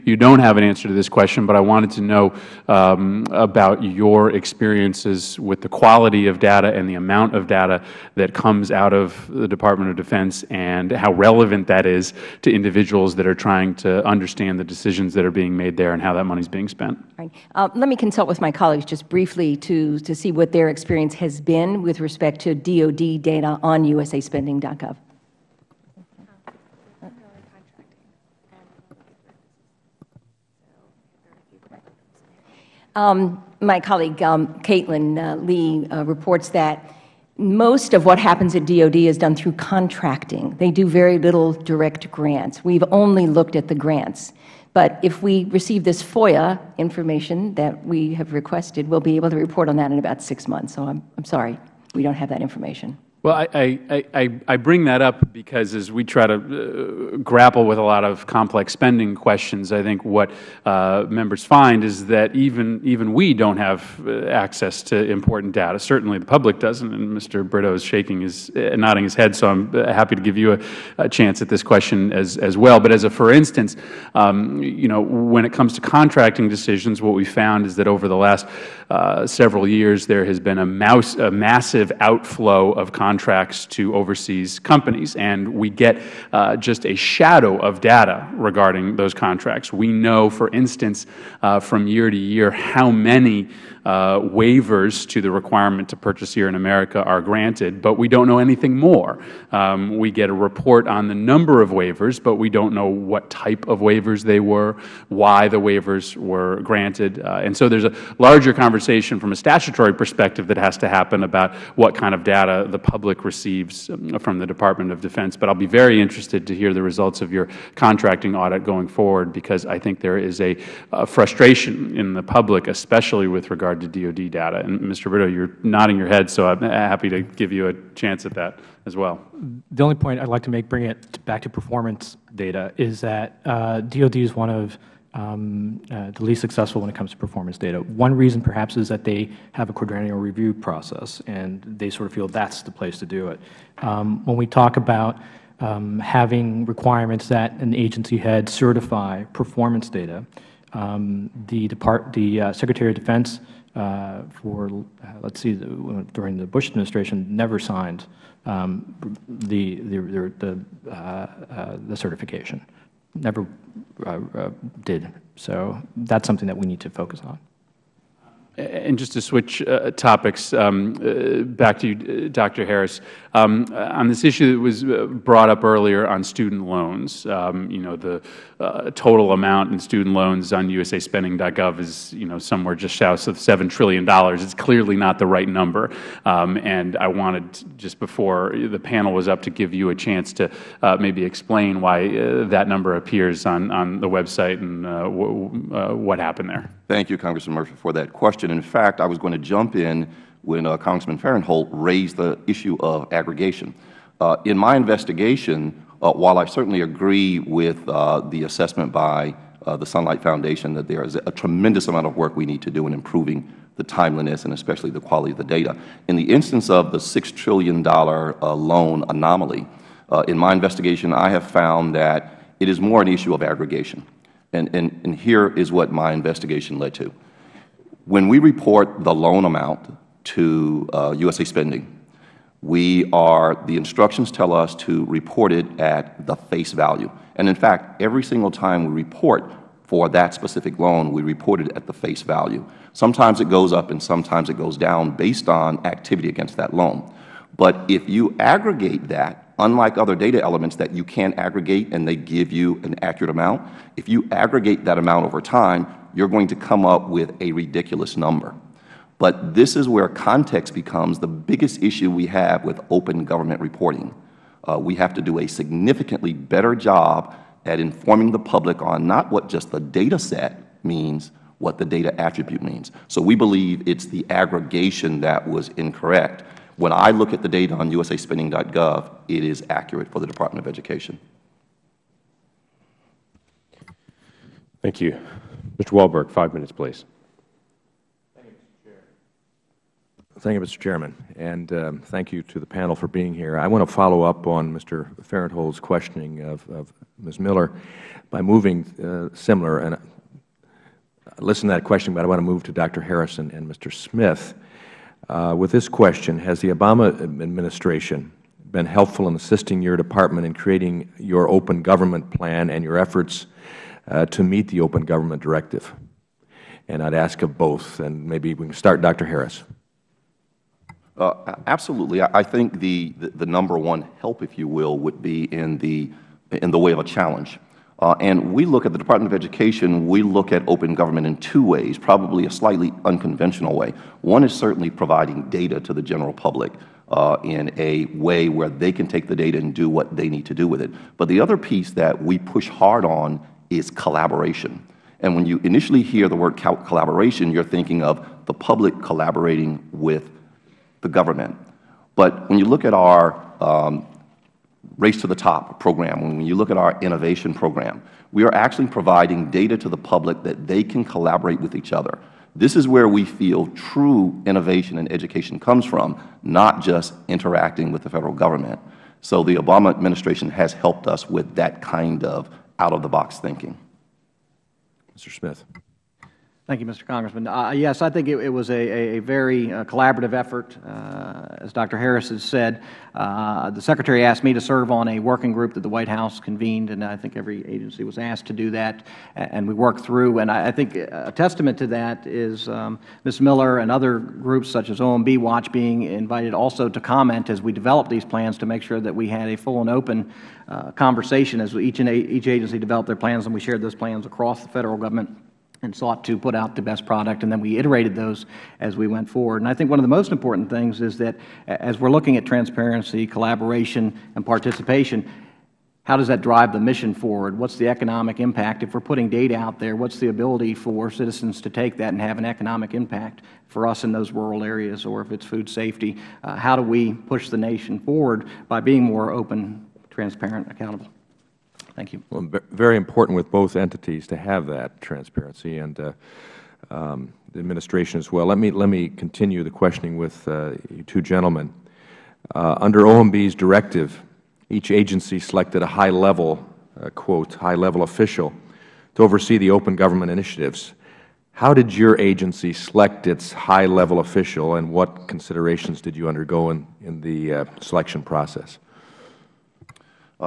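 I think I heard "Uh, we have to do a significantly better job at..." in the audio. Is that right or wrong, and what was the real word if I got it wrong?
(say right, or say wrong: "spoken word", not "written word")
right.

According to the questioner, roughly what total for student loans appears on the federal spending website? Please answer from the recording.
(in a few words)
just south of $7 trillion.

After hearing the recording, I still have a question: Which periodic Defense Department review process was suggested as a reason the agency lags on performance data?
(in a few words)
quadrennial review.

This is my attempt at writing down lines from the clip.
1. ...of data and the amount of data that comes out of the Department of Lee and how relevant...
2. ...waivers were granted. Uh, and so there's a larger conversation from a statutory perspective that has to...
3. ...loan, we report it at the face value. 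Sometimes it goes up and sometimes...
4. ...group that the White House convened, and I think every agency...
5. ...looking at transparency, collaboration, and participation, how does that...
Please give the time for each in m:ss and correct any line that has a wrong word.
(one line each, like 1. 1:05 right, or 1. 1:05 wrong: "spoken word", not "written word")
1. 0:06 wrong: "Defense", not "Lee"
2. 1:45 right
3. 4:00 right
4. 6:25 right
5. 6:52 right.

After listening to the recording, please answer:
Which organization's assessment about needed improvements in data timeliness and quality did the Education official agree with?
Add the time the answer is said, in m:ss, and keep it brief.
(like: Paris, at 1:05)
Sunlight Foundation, at 3:29.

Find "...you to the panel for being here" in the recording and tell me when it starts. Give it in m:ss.
4:52.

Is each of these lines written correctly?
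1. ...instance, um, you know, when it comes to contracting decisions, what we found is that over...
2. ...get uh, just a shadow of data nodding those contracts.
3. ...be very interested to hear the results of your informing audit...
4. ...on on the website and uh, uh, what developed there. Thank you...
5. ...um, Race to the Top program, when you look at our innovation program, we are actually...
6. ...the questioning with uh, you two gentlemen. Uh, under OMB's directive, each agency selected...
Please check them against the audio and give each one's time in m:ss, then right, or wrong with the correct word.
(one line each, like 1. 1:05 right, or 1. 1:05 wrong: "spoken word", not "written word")
1. 1:13 right
2. 1:25 wrong: "regarding", not "nodding"
3. 1:55 wrong: "contracting", not "informing"
4. 3:13 wrong: "happened", not "developed"
5. 5:53 right
6. 7:19 right.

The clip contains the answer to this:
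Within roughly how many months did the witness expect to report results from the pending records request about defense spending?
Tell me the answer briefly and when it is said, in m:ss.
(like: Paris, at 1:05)
6 months, at 0:50.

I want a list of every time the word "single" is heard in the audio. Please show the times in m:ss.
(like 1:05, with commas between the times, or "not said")
3:58.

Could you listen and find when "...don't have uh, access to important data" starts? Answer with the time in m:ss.
1:03.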